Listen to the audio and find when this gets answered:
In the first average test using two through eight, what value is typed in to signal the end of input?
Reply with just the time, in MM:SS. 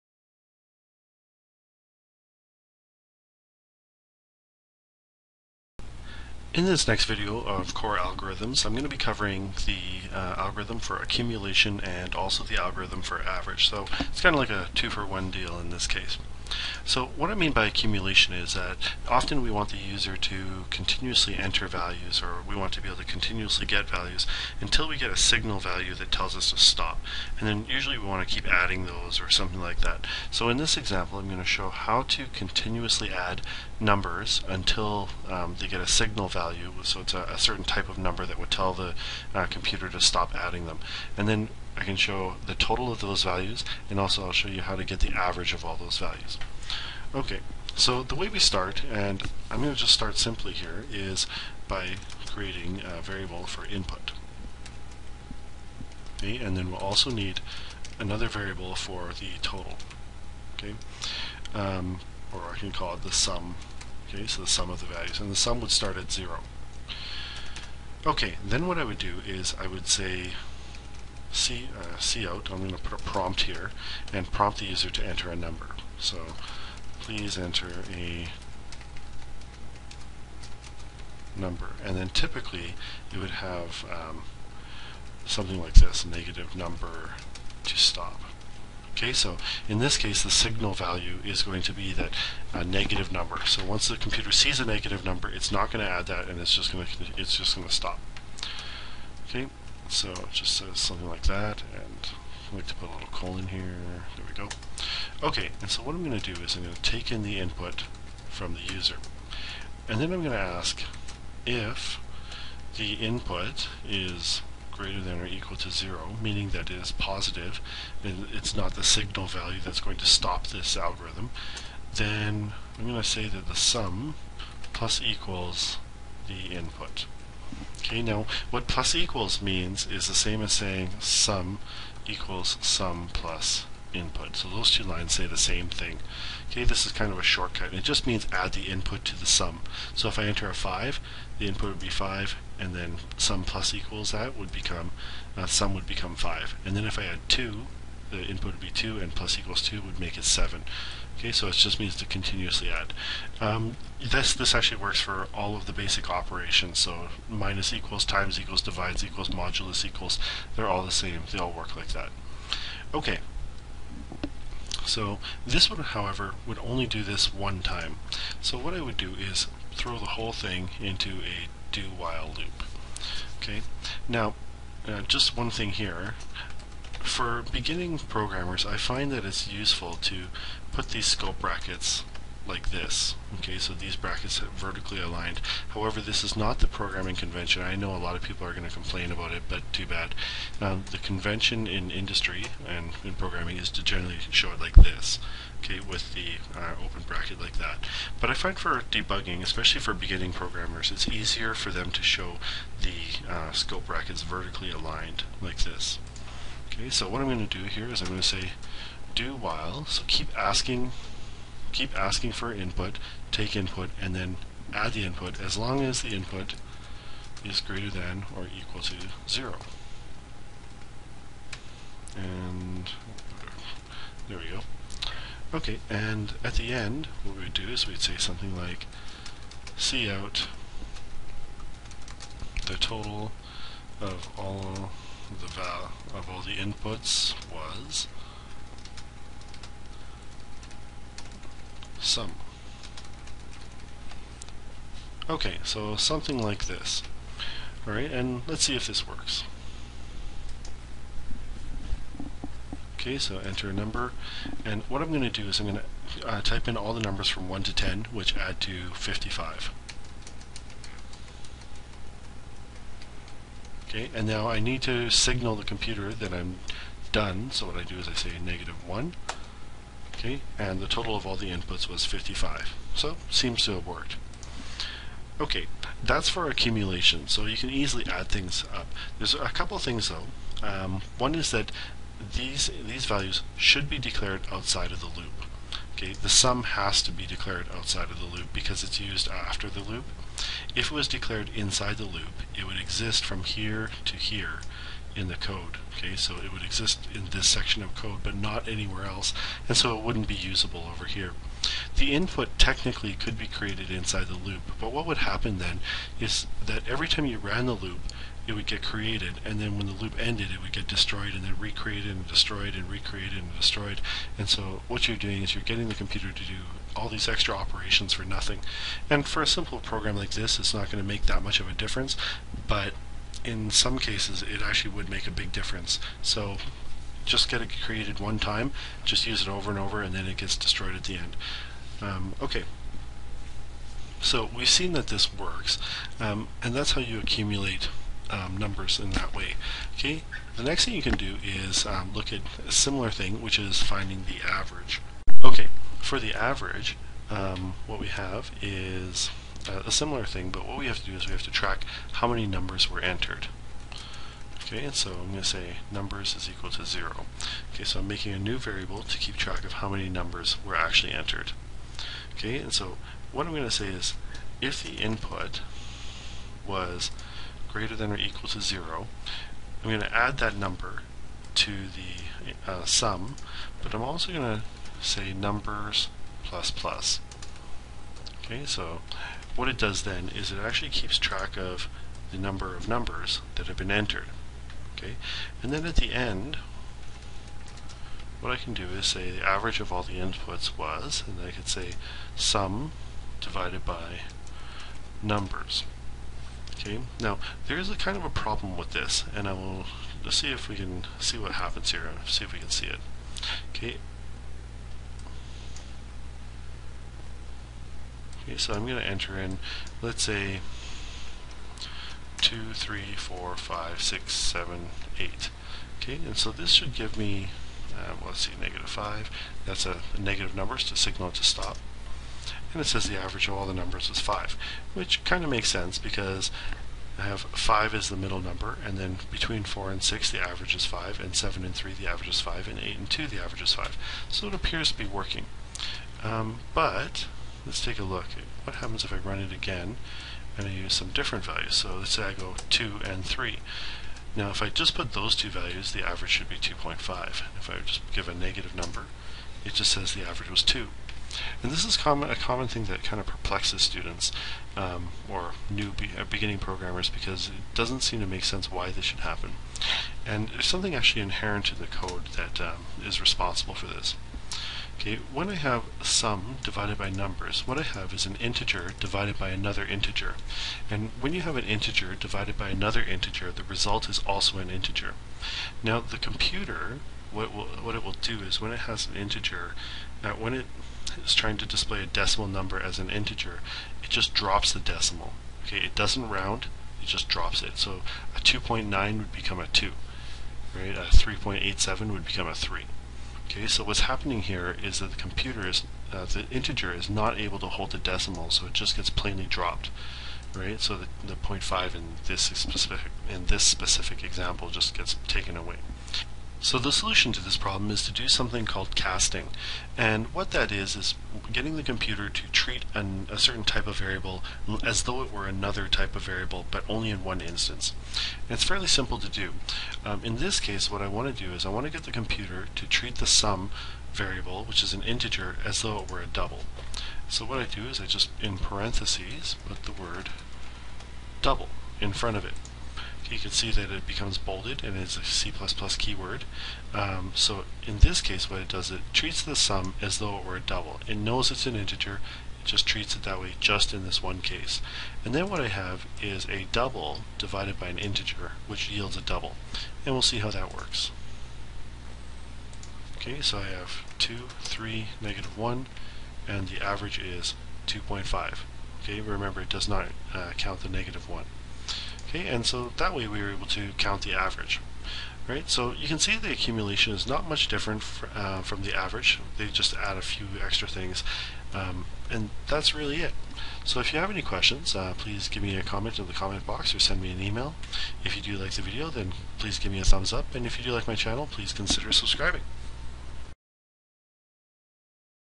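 06:58.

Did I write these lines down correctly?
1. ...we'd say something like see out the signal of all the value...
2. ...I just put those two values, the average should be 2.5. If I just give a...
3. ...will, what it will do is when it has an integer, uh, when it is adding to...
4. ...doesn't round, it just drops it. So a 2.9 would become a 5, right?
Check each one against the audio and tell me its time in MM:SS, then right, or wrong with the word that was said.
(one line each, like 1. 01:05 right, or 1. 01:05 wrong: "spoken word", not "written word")
1. 03:47 wrong: "total", not "signal"
2. 07:24 right
3. 07:57 wrong: "trying", not "adding"
4. 08:05 wrong: "2", not "5".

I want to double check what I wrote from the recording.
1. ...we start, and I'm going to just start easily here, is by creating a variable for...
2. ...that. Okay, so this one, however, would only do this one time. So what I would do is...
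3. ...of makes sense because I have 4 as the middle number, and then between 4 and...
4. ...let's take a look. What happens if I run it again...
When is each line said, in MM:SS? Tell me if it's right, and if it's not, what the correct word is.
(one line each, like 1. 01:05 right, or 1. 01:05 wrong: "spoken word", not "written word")
1. 00:48 wrong: "simply", not "easily"
2. 02:41 right
3. 07:05 wrong: "5", not "4"
4. 07:17 right.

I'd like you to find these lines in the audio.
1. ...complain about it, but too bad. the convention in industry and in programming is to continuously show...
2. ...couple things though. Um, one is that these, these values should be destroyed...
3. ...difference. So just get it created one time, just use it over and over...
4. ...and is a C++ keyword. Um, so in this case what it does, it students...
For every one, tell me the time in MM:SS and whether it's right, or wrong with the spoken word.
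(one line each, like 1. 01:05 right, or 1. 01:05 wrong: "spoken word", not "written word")
1. 03:08 wrong: "generally", not "continuously"
2. 04:39 wrong: "declared", not "destroyed"
3. 05:25 right
4. 08:54 wrong: "treats", not "students".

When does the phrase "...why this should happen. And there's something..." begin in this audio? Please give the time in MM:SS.
07:38.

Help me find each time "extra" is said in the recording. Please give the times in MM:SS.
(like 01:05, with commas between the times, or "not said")
05:17, 09:30.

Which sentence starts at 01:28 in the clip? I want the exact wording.
Okay, so in this case the signal value is going to be that a uh, negative number.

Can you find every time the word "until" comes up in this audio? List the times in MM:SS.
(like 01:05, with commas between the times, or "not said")
00:24, 00:34.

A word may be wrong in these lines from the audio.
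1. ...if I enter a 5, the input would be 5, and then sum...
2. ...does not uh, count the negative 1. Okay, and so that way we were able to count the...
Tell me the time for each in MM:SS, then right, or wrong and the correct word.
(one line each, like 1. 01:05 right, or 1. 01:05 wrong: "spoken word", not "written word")
1. 02:20 right
2. 09:19 right.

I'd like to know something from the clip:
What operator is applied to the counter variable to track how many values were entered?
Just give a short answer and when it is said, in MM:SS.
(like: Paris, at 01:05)
plus plus, at 06:16.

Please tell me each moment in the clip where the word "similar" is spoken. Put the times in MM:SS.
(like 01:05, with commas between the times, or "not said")
05:42, 05:49.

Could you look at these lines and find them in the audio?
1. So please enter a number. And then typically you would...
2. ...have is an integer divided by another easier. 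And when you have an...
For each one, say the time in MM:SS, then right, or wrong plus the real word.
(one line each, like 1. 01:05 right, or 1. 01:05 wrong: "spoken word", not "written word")
1. 01:15 right
2. 07:47 wrong: "integer", not "easier".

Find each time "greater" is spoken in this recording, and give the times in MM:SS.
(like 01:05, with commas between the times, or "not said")
01:54, 03:37, 06:07.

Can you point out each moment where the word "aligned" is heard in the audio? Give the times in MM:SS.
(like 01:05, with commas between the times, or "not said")
03:05, 03:24.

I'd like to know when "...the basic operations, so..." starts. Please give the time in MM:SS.
02:35.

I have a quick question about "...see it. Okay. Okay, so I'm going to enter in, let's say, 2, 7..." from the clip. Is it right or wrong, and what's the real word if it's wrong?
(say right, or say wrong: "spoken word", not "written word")
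wrong: "3", not "7".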